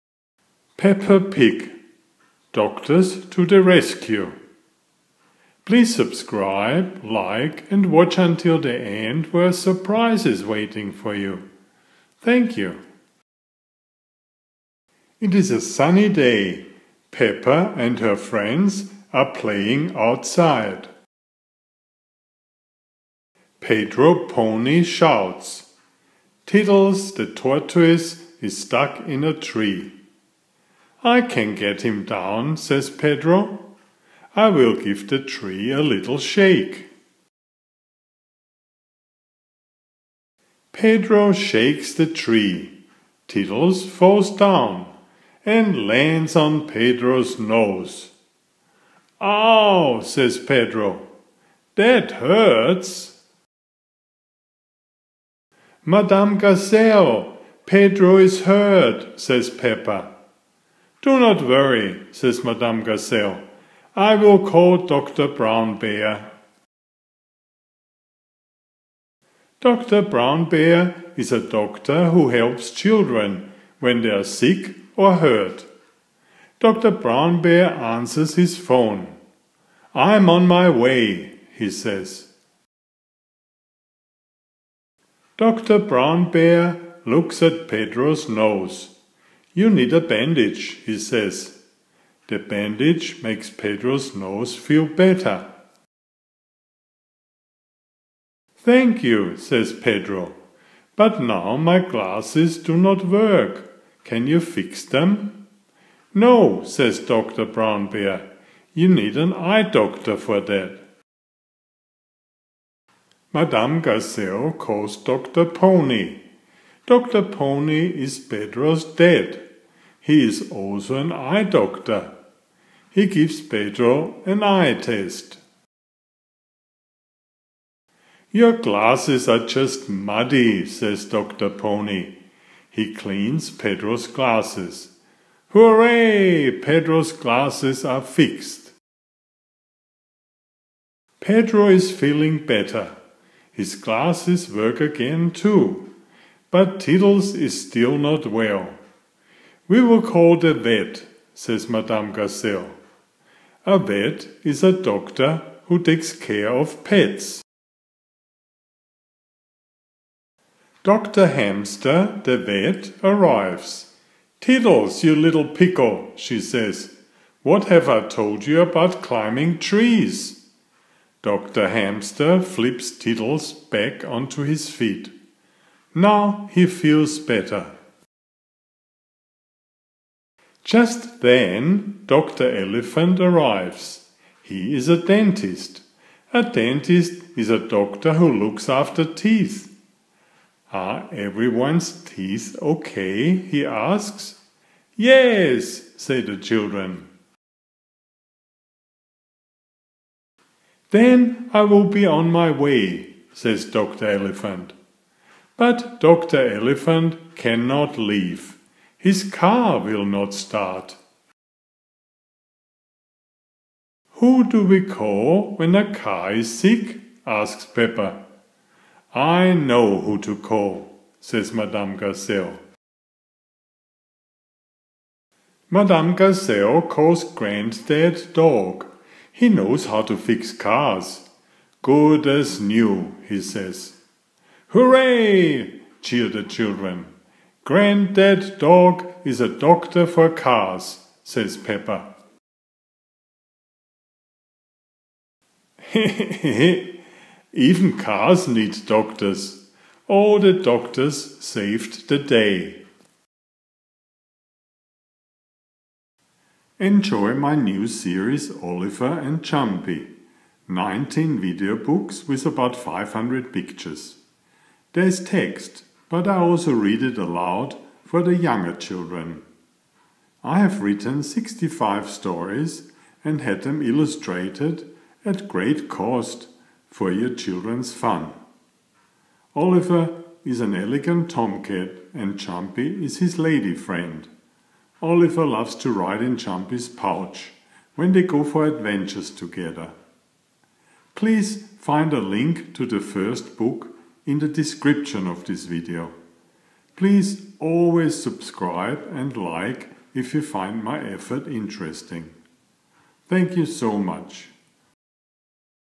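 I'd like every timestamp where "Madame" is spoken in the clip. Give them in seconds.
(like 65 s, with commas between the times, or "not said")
55 s, 62 s, 113 s, 151 s, 221 s, 225 s.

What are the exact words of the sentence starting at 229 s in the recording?
He knows how to fix cars.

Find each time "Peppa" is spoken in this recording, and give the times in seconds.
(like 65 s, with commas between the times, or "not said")
0 s, 17 s, 59 s, 217 s, 241 s.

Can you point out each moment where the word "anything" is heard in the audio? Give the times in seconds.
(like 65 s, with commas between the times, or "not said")
not said.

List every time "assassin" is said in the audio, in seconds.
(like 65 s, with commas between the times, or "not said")
not said.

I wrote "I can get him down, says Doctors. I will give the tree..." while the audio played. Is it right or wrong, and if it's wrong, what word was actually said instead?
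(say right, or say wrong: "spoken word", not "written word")
wrong: "Pedro", not "Doctors".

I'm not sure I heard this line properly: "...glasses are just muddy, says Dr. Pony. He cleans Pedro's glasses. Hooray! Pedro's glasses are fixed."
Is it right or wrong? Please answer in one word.
right.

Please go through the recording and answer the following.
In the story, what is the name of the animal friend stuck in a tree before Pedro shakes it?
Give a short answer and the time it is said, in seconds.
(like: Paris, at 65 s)
Tiddles the tortoise, at 26 s.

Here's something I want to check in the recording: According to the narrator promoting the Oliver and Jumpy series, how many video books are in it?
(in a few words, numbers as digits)
19.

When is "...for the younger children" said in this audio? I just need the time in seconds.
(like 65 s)
268 s.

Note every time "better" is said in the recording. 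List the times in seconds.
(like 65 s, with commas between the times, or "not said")
94 s, 142 s, 177 s.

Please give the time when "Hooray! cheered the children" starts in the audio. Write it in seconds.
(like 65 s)
234 s.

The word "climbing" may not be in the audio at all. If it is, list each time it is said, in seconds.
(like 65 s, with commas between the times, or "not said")
169 s.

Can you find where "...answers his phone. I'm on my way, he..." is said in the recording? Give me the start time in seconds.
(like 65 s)
77 s.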